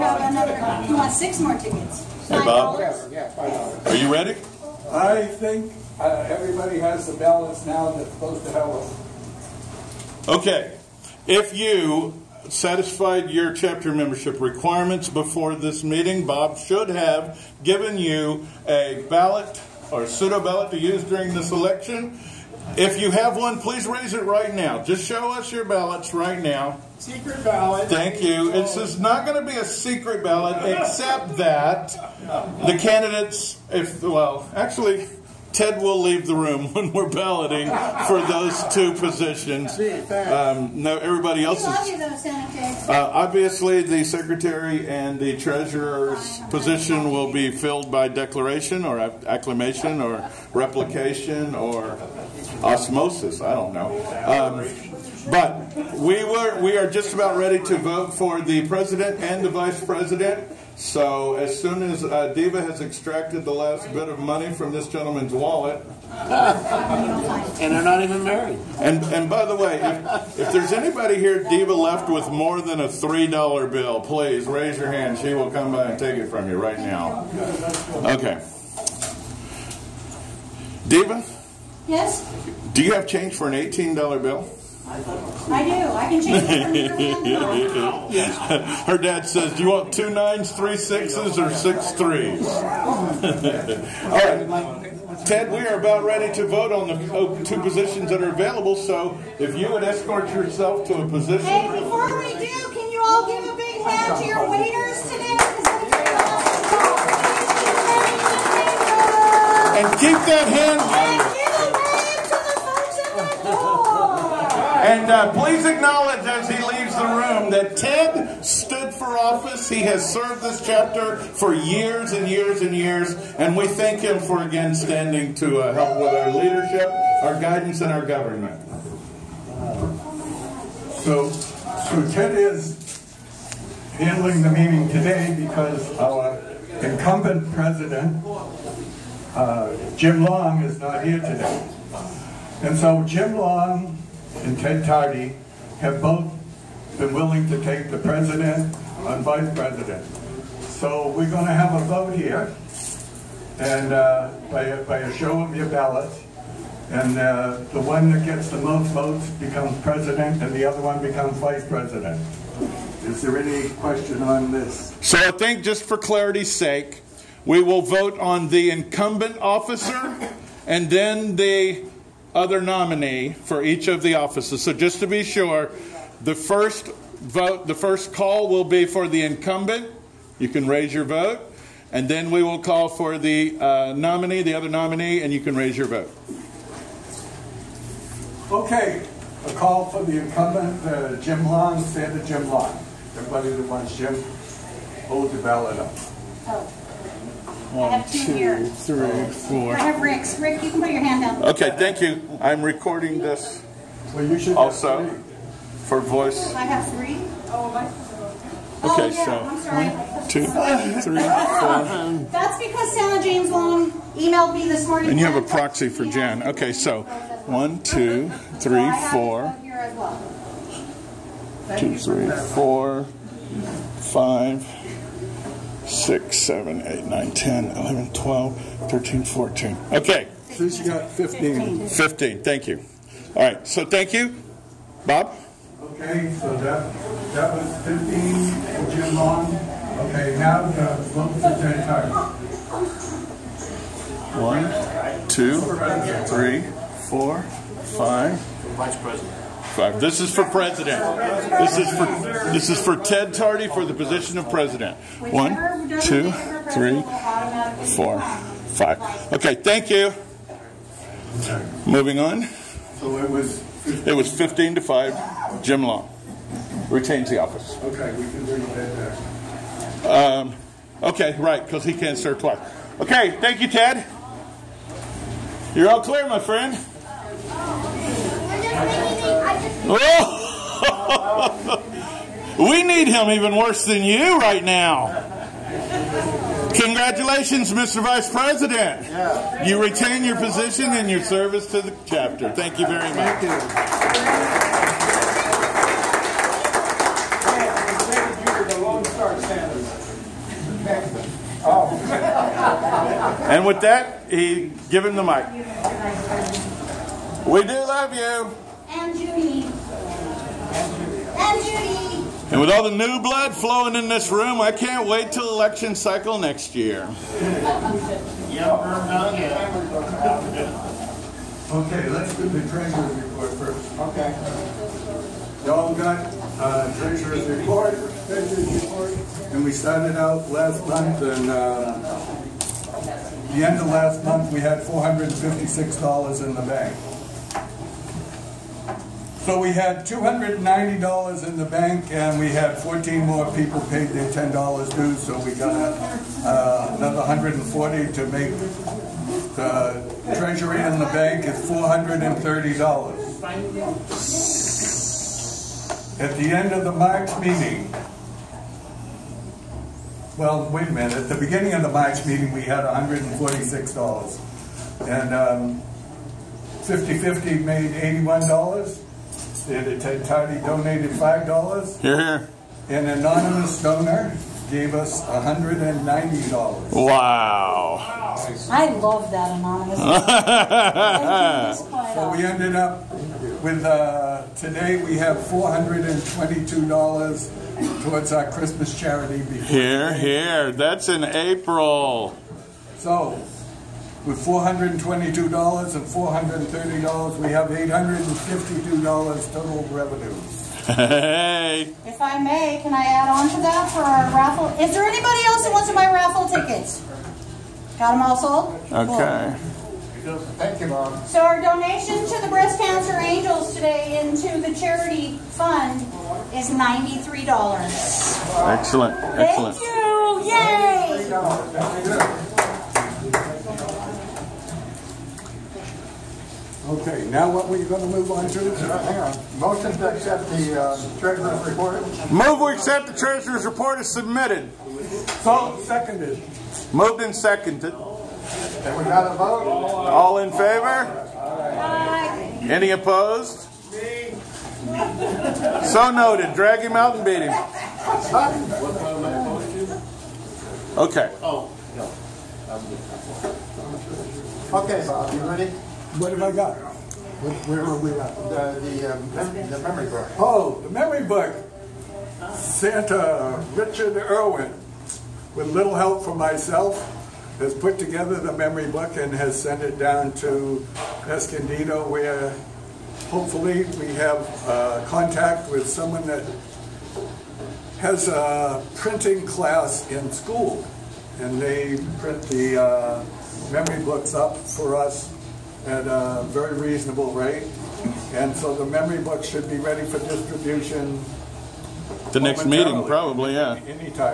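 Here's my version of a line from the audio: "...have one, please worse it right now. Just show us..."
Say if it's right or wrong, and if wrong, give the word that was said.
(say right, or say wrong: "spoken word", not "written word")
wrong: "raise", not "worse".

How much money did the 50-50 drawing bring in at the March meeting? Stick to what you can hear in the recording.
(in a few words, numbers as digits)
$81.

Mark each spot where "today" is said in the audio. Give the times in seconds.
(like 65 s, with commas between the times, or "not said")
105 s, 134 s, 141 s, 384 s, 413 s.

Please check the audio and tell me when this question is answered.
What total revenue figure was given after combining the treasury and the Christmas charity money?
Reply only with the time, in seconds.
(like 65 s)
397 s.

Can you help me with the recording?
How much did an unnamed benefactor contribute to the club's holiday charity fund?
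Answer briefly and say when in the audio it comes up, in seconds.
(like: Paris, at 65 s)
$190, at 375 s.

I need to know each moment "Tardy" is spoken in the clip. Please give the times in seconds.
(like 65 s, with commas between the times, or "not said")
144 s, 253 s.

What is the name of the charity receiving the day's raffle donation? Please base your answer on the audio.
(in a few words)
Breast Cancer Angels.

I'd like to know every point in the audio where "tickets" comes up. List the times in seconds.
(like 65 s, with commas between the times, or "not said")
1 s, 406 s.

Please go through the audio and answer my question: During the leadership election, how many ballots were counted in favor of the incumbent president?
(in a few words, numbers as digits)
15.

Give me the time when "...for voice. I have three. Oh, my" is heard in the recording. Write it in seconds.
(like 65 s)
205 s.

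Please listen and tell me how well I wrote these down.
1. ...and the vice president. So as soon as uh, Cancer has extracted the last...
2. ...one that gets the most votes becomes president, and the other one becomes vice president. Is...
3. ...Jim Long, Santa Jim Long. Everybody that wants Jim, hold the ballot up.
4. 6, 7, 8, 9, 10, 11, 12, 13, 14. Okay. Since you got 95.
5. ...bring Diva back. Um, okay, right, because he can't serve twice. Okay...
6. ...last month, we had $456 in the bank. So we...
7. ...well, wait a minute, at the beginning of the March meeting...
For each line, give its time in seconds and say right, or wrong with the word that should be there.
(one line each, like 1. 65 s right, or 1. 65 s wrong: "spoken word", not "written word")
1. 59 s wrong: "Diva", not "Cancer"
2. 157 s right
3. 191 s right
4. 225 s wrong: "15", not "95"
5. 268 s wrong: "Ted", not "Diva"
6. 333 s right
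7. 360 s right.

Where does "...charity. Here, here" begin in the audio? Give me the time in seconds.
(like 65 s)
388 s.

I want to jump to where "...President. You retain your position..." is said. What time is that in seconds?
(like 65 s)
288 s.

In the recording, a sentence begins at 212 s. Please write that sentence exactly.
That's because Santa James Long emailed me this morning.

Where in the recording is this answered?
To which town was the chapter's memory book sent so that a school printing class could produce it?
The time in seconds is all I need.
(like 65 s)
471 s.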